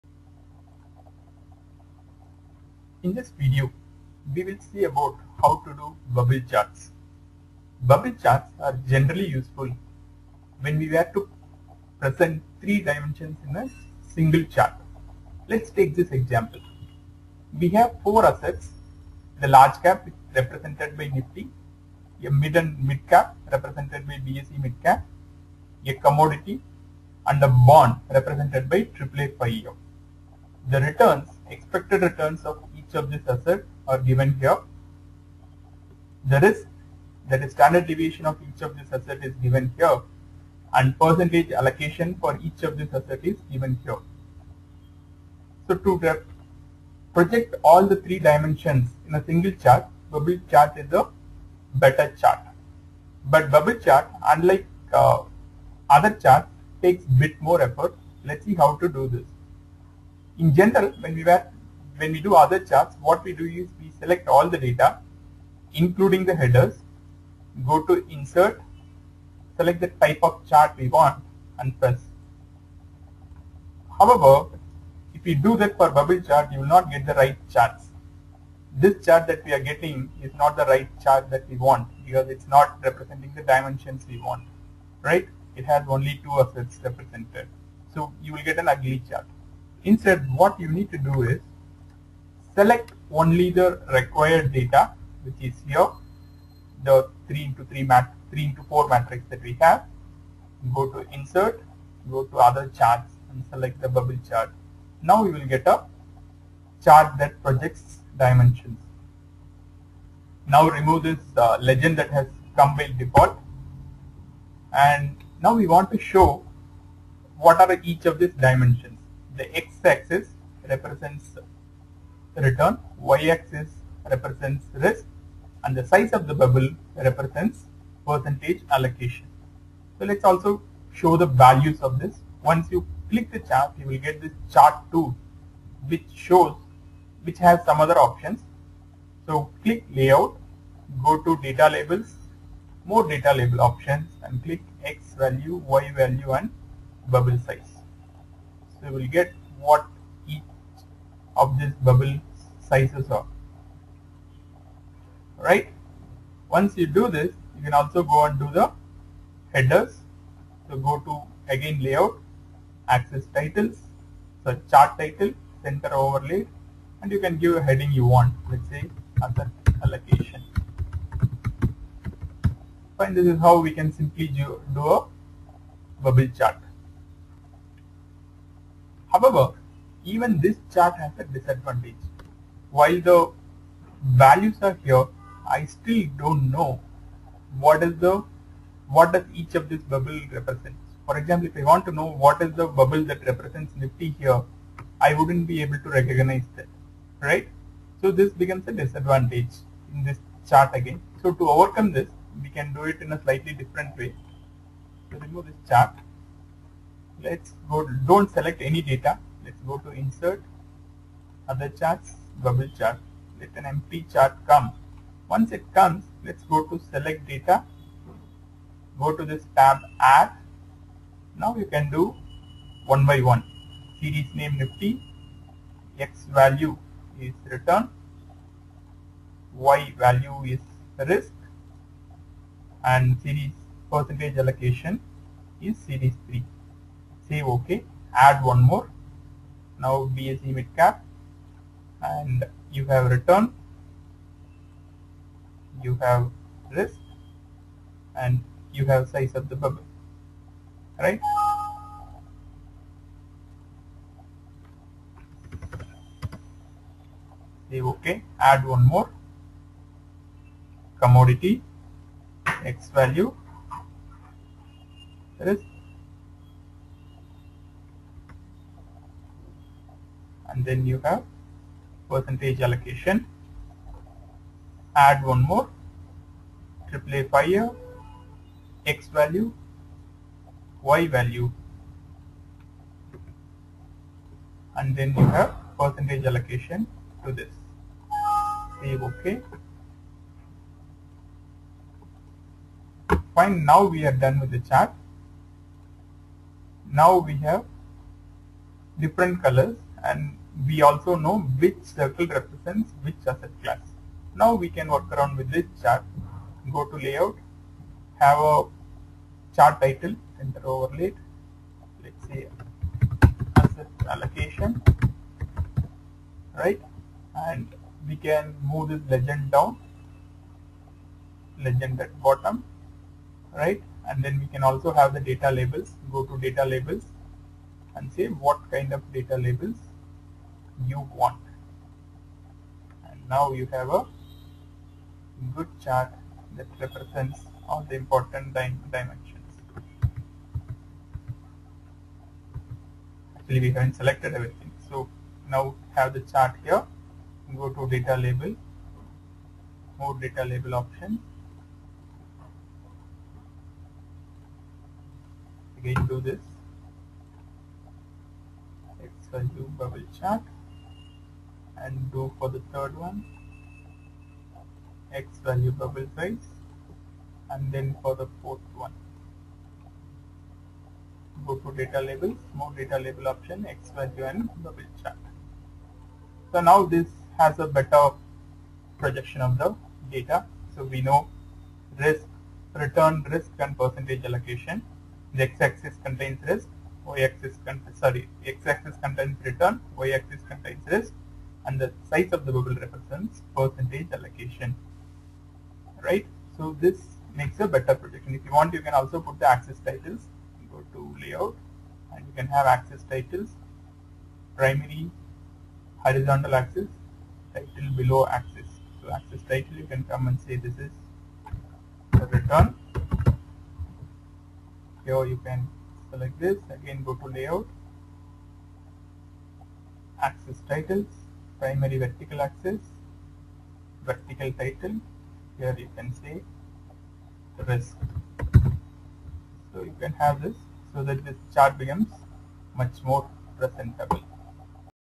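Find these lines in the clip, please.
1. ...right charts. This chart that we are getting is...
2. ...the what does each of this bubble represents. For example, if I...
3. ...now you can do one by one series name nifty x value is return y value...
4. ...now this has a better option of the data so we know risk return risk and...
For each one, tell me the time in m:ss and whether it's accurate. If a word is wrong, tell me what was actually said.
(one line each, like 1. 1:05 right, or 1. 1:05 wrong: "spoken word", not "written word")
1. 1:17 right
2. 3:07 right
3. 3:41 right
4. 6:16 wrong: "projection", not "option".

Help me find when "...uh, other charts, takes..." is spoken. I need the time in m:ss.
0:54.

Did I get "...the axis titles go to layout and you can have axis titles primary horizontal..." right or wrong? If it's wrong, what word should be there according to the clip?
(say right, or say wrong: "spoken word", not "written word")
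right.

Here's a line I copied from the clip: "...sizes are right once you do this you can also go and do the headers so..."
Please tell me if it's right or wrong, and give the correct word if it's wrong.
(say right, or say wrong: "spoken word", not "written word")
right.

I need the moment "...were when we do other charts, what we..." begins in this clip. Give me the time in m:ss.
1:01.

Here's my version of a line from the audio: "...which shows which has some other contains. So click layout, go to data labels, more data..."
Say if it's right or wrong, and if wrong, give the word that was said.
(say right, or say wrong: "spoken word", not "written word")
wrong: "options", not "contains".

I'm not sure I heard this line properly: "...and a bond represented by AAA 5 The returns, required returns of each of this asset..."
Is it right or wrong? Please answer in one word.
wrong.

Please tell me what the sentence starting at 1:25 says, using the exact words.
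It has only two assets represented.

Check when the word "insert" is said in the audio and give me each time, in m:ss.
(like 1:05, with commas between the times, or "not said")
1:08, 1:41, 3:30.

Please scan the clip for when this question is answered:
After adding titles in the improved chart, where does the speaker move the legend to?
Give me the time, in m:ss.
5:21.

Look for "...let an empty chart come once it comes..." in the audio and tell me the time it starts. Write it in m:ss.
3:33.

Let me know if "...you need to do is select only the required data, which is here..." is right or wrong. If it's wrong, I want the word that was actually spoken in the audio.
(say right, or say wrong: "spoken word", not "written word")
right.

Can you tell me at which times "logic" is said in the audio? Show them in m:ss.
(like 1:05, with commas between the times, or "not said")
not said.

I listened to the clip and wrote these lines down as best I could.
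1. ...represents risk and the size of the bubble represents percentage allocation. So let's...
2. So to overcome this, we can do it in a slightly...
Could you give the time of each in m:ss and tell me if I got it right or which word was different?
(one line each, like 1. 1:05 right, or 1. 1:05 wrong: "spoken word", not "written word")
1. 2:04 right
2. 3:21 right.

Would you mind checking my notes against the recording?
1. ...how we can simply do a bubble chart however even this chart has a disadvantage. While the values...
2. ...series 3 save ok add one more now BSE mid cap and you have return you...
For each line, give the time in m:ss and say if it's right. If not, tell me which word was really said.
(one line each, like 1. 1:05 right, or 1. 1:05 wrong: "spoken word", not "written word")
1. 2:53 right
2. 3:55 right.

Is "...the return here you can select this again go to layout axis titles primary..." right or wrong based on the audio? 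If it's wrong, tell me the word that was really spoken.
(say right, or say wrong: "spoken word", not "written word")
right.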